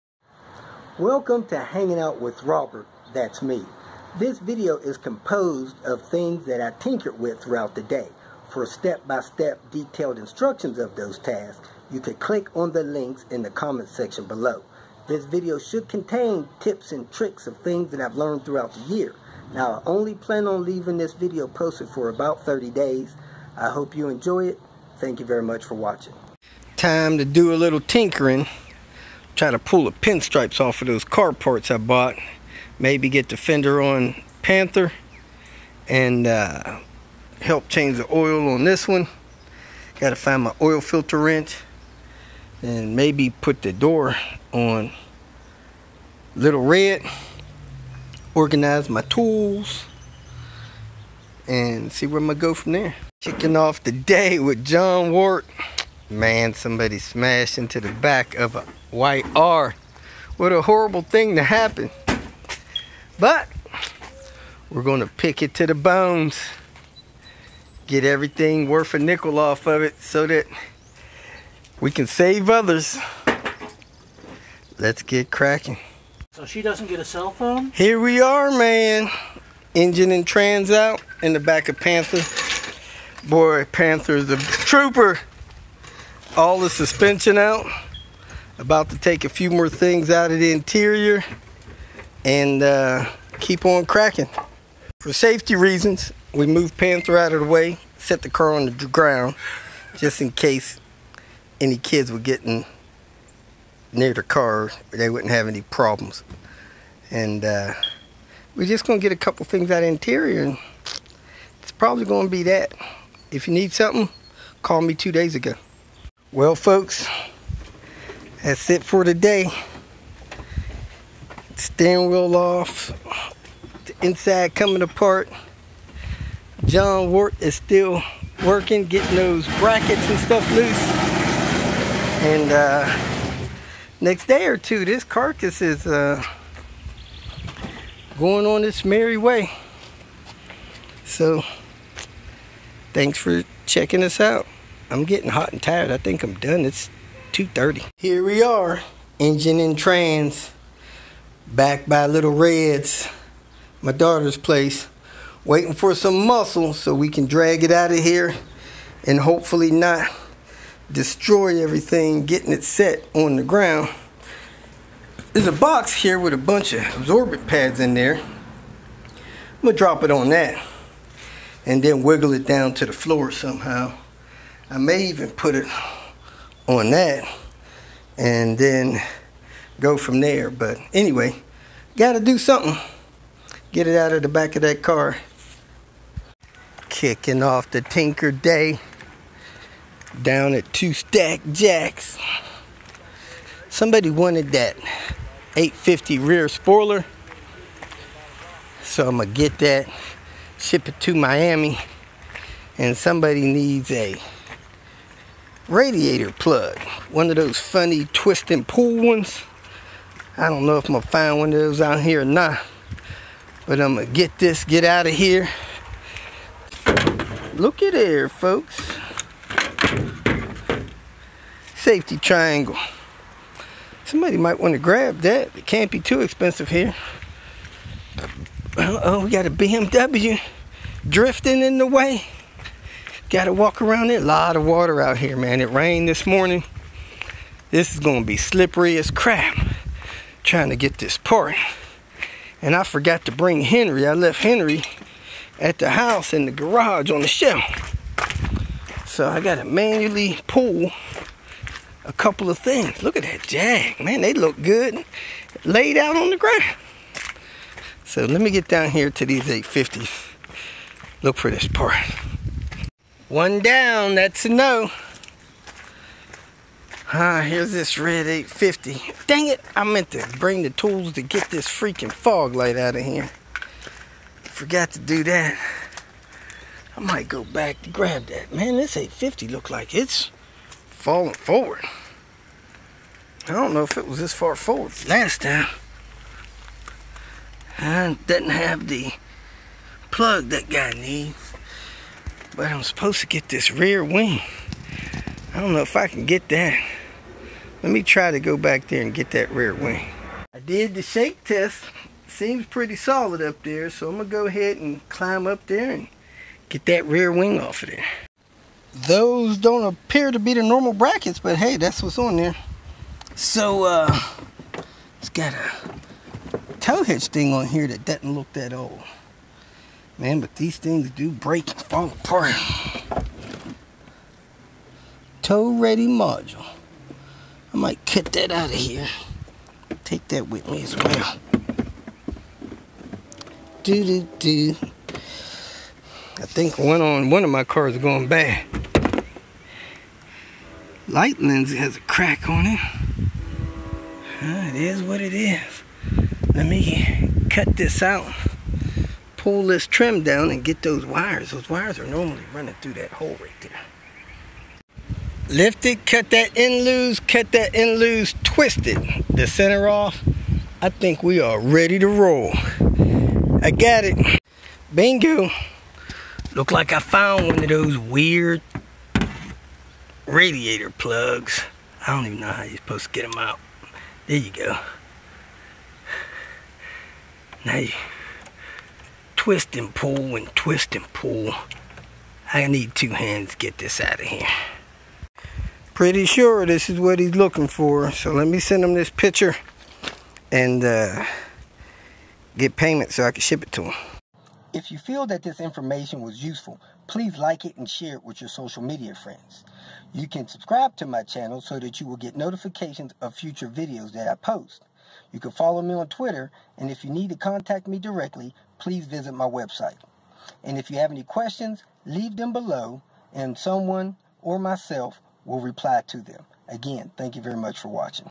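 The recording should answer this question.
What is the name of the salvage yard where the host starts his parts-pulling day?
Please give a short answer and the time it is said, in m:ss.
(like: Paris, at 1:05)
Two Stack Jacks, at 3:10.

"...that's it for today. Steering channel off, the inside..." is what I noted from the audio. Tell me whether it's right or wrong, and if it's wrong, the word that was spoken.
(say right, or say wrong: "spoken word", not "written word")
wrong: "wheel", not "channel".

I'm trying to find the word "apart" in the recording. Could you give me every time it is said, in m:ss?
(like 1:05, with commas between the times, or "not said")
2:04, 5:22.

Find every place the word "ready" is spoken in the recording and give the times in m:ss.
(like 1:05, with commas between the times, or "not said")
5:25, 6:01.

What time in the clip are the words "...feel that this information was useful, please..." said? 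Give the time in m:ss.
6:34.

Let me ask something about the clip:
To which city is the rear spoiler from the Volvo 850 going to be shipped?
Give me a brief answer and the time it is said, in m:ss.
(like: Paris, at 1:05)
Miami, at 3:21.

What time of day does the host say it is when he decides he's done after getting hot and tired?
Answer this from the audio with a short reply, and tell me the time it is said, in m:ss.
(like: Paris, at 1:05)
2:30, at 2:27.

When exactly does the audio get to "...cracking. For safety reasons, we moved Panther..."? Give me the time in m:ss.
1:33.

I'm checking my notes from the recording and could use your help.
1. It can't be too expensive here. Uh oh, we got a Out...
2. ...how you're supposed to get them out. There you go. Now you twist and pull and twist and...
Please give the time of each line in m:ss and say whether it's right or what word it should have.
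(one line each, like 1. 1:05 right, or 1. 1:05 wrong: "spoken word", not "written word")
1. 3:45 wrong: "BMW", not "Out"
2. 6:12 right.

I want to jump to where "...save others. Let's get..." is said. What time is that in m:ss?
1:12.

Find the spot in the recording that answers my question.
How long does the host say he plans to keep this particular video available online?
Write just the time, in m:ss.
0:22.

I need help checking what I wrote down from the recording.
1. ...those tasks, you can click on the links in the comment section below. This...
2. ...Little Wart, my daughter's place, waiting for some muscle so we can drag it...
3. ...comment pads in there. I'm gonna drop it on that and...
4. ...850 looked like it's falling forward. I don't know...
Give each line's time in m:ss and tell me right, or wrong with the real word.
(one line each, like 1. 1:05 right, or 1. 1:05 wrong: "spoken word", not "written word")
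1. 0:10 right
2. 2:32 wrong: "Reds", not "Wart"
3. 2:46 wrong: "absorbent", not "comment"
4. 4:38 right.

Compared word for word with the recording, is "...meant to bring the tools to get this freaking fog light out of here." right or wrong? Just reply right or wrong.
right.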